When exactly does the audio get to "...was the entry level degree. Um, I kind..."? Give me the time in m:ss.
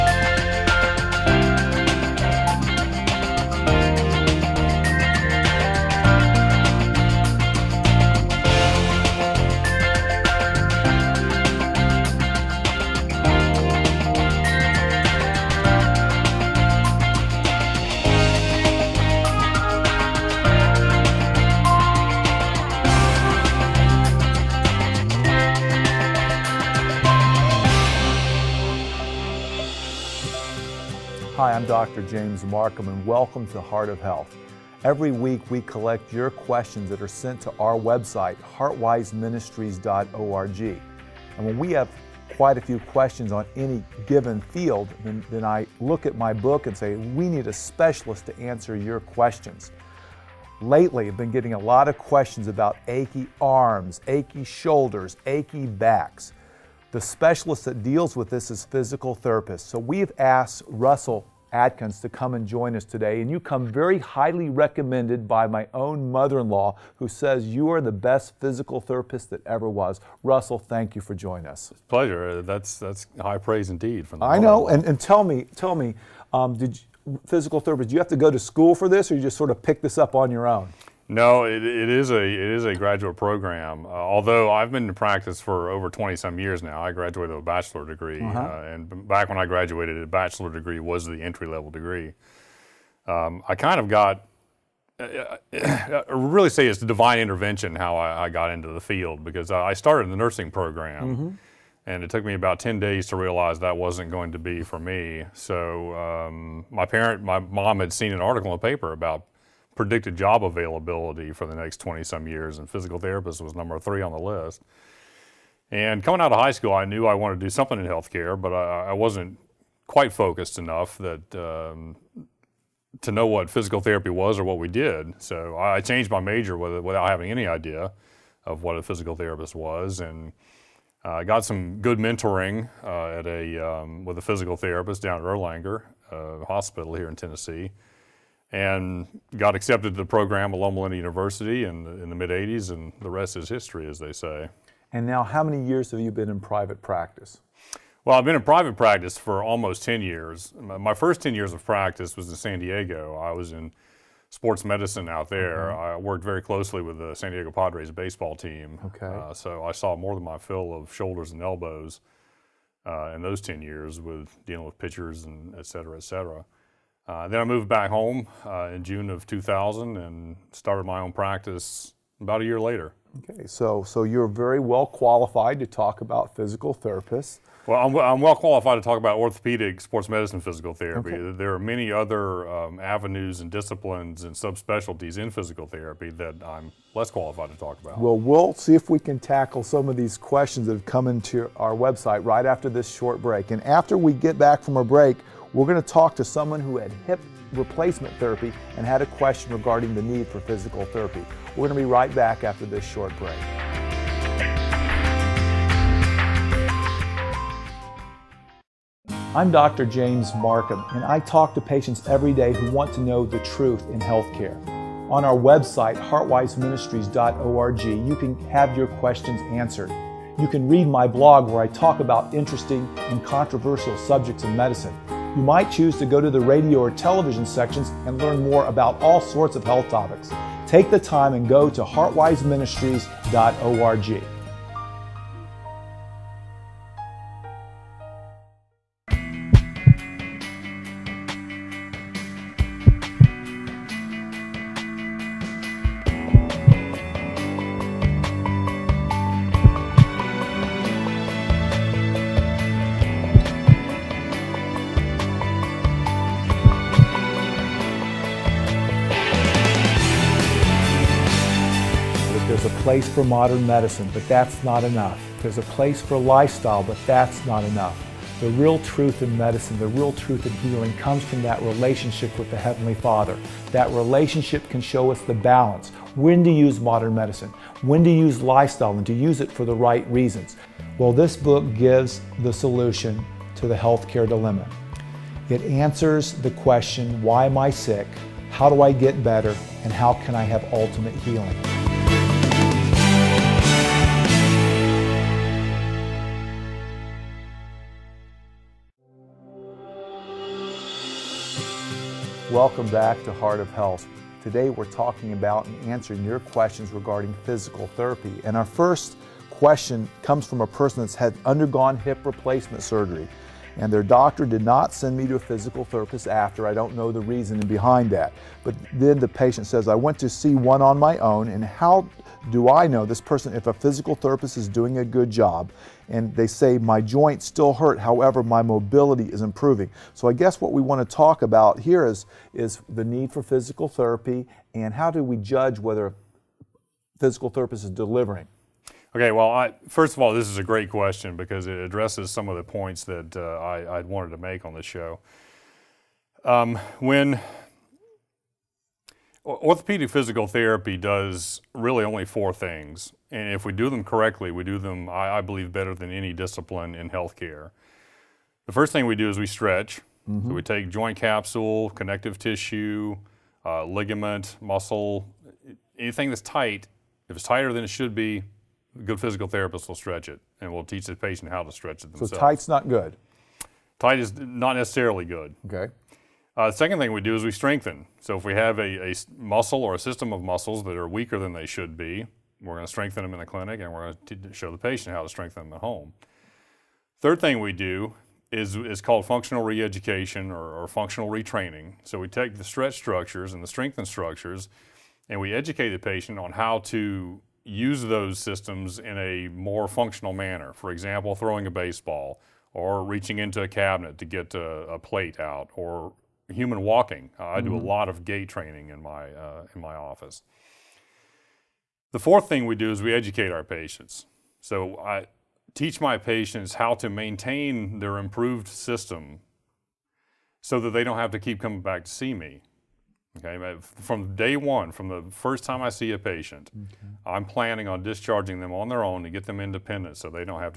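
1:30.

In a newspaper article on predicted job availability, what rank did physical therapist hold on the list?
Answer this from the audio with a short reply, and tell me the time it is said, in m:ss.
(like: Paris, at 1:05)
3, at 1:53.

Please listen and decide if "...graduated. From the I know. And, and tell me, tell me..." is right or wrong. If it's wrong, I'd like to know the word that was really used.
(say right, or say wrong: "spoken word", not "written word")
wrong: "indeed", not "graduated".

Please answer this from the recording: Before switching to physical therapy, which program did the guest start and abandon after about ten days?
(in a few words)
nursing.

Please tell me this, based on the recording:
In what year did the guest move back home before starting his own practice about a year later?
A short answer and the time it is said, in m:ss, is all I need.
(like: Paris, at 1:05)
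2000, at 2:48.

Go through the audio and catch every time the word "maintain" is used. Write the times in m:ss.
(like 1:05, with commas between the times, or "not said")
6:57.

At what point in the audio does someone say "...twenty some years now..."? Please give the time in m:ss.
1:25.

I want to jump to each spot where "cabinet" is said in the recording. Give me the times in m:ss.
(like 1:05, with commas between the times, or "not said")
6:43.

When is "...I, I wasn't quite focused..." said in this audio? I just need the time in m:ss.
1:58.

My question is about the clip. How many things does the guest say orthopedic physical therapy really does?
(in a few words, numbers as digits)
4.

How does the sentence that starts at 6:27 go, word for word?
Third thing we do is, is called functional re-education or, or functional retraining.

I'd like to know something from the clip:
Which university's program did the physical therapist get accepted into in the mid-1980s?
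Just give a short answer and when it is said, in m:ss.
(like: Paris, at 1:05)
Loma Linda University, at 2:20.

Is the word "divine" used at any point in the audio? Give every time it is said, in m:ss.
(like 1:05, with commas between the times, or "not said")
1:36.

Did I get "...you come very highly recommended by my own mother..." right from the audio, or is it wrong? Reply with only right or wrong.
right.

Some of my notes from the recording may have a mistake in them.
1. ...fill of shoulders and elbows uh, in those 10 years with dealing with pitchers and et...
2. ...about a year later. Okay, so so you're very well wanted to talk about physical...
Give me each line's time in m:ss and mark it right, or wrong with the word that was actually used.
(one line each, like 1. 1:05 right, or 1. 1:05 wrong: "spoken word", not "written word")
1. 2:40 right
2. 2:52 wrong: "qualified", not "wanted".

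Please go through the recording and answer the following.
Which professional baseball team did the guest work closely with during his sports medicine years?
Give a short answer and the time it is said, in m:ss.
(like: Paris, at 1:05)
San Diego Padres, at 2:37.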